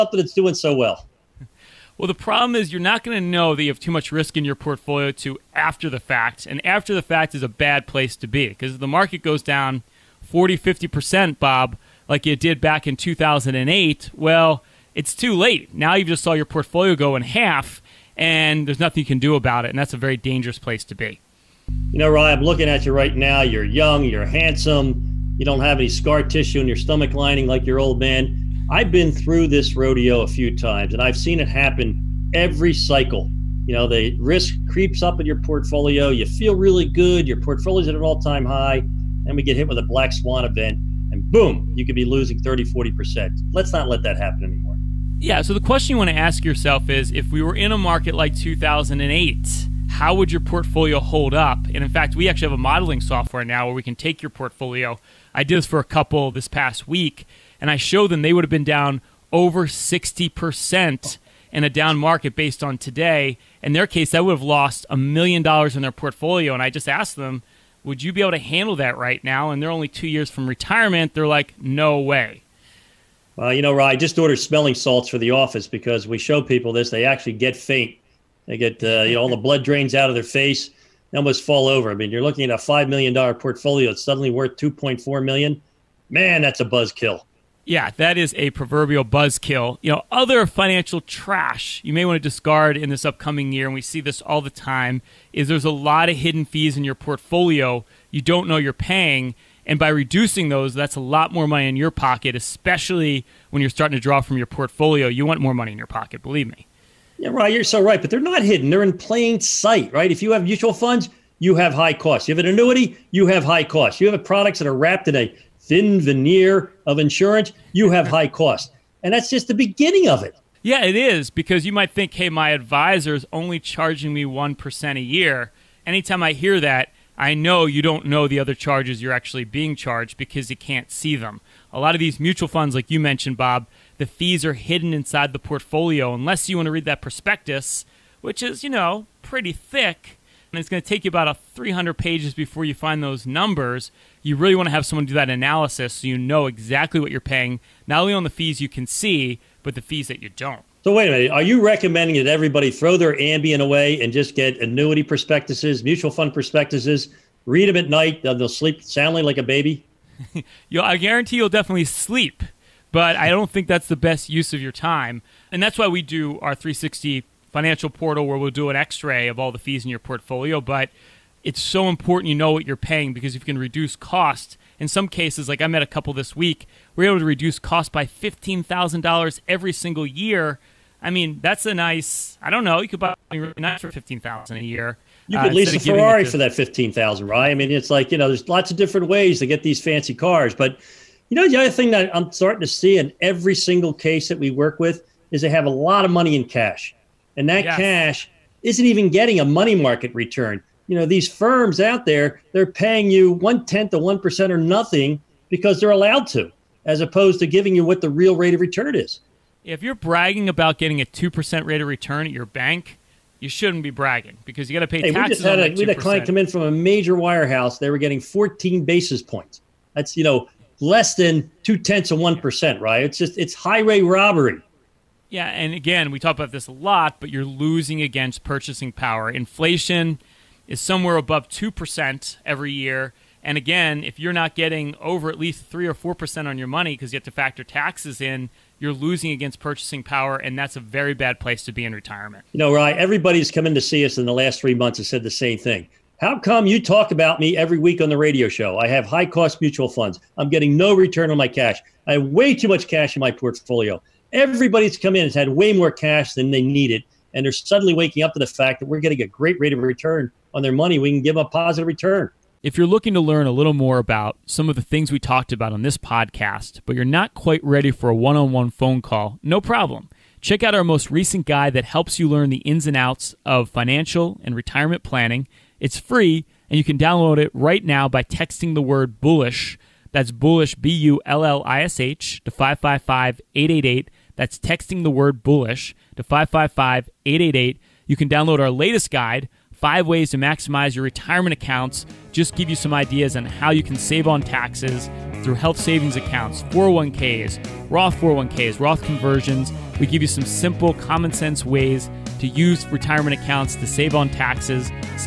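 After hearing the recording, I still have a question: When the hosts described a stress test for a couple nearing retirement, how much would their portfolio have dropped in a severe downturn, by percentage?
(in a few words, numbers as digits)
over 60%.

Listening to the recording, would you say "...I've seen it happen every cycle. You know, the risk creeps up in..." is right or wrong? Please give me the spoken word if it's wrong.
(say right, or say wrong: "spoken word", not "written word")
right.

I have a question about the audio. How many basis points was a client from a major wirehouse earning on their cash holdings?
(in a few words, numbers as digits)
14.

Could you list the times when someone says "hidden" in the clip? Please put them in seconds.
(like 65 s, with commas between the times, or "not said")
96 s, 108 s, 134 s.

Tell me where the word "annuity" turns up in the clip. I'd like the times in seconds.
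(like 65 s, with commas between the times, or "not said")
112 s, 154 s.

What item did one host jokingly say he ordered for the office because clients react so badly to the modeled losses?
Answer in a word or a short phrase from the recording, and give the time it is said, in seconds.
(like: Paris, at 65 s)
smelling salts, at 74 s.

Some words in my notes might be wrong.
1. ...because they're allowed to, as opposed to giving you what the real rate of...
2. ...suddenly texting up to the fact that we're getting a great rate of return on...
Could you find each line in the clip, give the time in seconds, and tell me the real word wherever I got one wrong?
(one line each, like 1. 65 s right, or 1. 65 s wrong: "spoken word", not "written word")
1. 205 s right
2. 257 s wrong: "waking", not "texting".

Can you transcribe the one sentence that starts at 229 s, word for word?
Inflation is somewhere above 2% every year.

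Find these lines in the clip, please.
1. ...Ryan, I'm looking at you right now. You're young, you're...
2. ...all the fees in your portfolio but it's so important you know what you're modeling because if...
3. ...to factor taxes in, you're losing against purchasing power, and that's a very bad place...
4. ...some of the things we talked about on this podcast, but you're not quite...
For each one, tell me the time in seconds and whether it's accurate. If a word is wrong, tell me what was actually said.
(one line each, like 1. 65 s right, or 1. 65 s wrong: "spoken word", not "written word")
1. 22 s right
2. 169 s wrong: "paying", not "modeling"
3. 237 s right
4. 264 s right.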